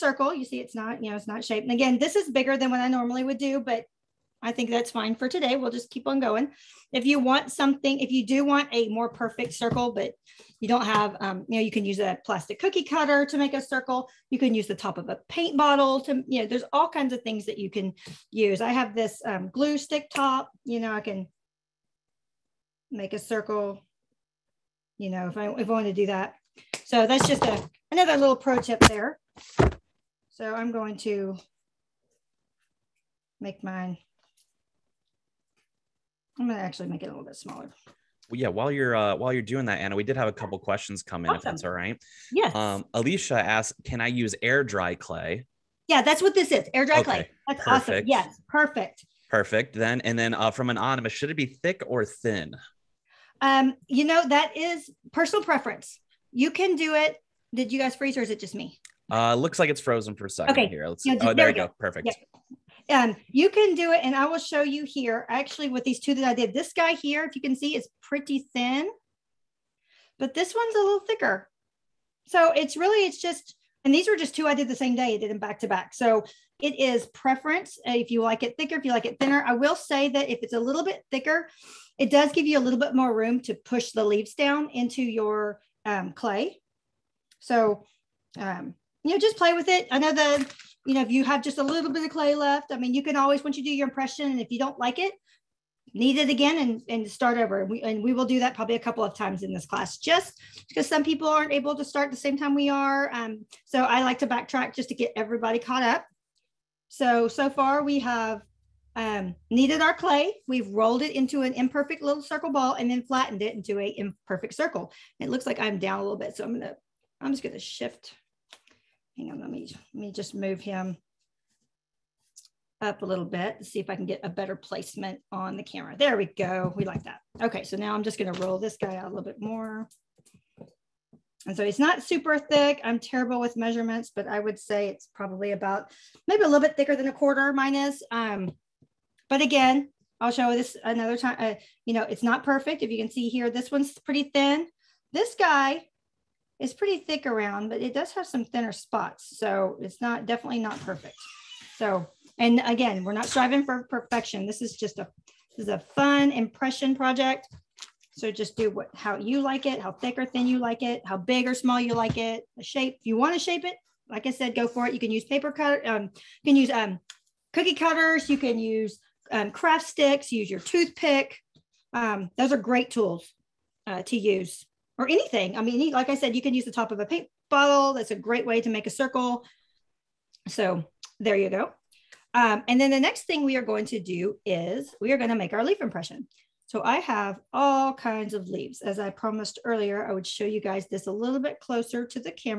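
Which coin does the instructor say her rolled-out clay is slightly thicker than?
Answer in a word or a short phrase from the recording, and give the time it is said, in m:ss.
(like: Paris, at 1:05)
A quarter, at 2:17.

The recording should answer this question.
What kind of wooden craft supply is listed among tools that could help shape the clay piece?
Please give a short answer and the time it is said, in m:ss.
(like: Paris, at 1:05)
Craft sticks, at 2:49.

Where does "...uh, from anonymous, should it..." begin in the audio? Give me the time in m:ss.
0:50.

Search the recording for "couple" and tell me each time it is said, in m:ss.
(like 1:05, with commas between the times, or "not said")
0:40, 1:38.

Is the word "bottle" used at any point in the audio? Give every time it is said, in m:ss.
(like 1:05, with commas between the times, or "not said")
0:15, 2:57.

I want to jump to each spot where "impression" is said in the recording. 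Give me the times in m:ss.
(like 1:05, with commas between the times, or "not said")
1:33, 2:36, 3:05.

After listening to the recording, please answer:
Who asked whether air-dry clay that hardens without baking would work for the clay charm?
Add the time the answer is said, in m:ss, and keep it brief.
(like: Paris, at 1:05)
Alicia, at 0:42.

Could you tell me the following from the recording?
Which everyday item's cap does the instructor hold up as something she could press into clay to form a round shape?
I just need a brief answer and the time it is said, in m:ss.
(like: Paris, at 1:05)
Glue stick, at 0:19.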